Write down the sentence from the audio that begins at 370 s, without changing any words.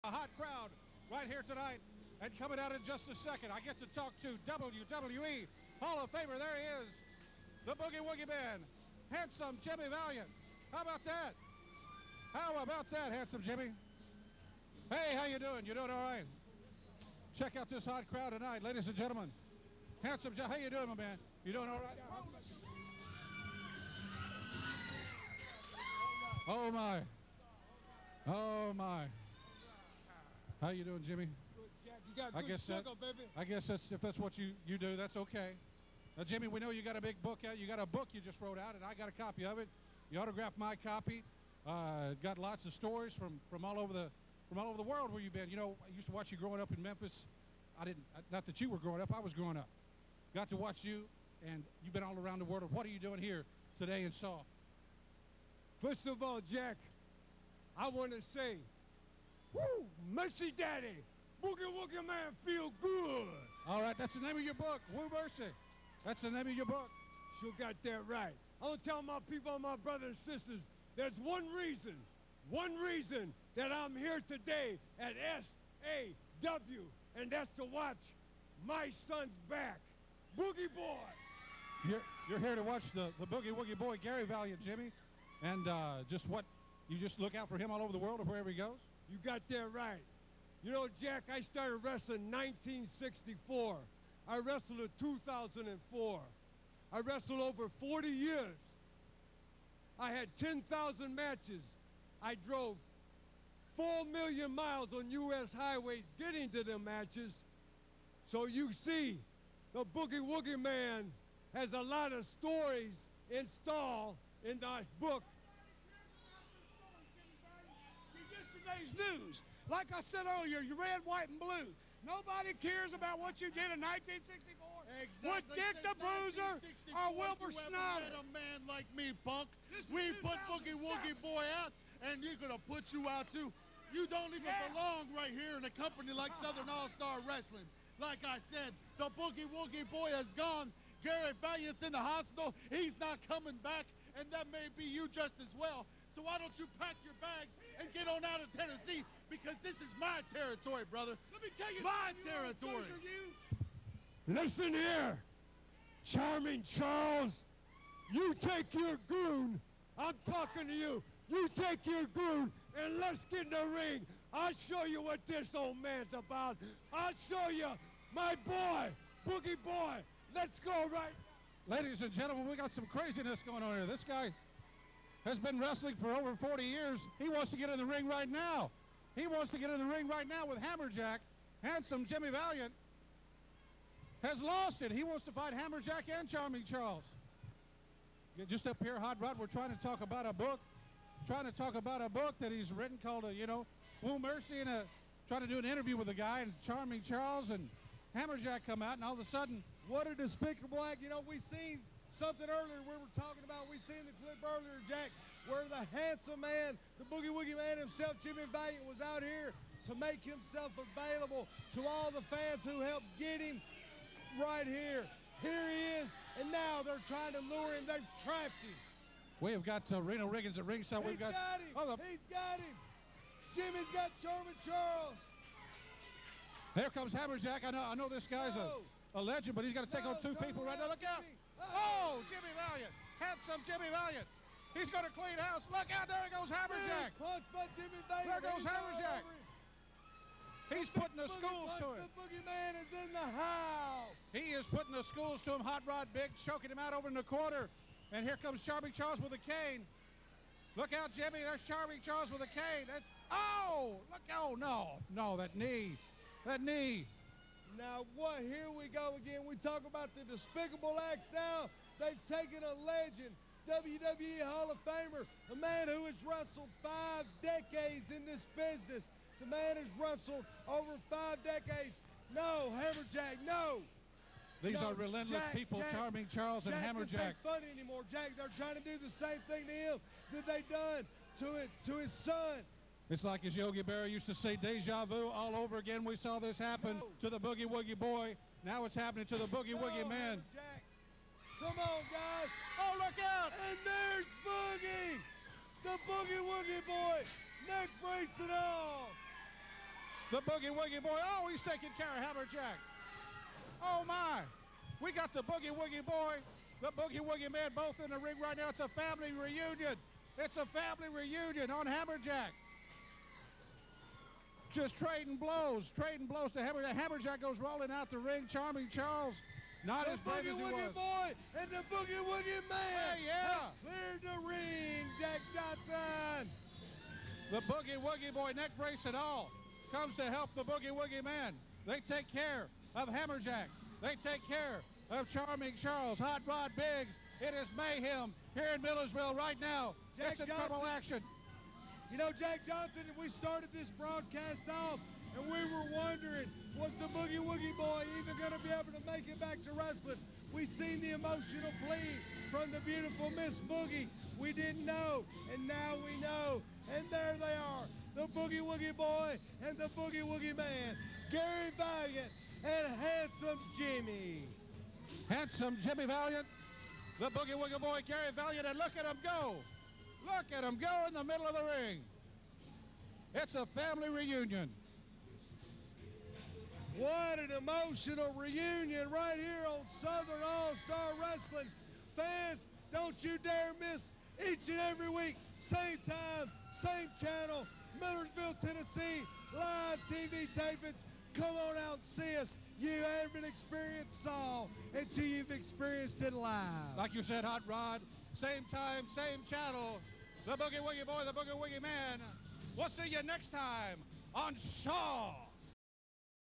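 Look at them go in the middle of the ring.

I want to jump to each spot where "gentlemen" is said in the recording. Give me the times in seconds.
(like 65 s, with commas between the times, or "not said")
18 s, 172 s.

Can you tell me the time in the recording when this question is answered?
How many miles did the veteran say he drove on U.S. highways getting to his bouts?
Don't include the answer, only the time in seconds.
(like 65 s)
103 s.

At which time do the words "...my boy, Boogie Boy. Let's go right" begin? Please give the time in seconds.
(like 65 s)
168 s.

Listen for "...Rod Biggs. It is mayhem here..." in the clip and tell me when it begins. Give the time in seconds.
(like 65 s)
336 s.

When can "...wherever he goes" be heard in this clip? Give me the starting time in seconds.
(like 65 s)
88 s.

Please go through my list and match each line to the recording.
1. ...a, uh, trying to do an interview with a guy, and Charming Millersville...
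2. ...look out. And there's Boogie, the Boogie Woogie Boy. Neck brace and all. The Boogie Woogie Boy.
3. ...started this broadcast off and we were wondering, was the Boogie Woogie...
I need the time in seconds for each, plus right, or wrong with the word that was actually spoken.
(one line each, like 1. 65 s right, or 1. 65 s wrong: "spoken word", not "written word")
1. 194 s wrong: "Charles", not "Millersville"
2. 292 s right
3. 343 s right.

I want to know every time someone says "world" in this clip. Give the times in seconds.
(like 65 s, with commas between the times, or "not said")
44 s, 52 s, 87 s.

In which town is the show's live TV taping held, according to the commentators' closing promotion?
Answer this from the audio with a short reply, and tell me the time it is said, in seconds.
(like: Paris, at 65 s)
Millersville, Tennessee, at 388 s.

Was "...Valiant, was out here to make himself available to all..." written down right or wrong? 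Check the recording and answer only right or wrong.
right.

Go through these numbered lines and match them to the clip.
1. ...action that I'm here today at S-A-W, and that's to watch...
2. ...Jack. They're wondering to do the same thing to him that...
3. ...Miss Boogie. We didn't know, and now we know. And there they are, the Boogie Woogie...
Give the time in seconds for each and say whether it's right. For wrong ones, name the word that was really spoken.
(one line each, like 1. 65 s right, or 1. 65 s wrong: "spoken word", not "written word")
1. 72 s wrong: "reason", not "action"
2. 278 s wrong: "trying", not "wondering"
3. 353 s right.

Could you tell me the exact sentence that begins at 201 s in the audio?
You know, we've seen something earlier we were talking about.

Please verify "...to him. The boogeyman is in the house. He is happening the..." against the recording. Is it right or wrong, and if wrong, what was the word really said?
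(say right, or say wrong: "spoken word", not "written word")
wrong: "putting", not "happening".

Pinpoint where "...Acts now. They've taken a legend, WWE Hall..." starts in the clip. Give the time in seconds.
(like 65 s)
261 s.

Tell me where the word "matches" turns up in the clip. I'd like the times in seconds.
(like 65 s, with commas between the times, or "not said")
101 s, 106 s.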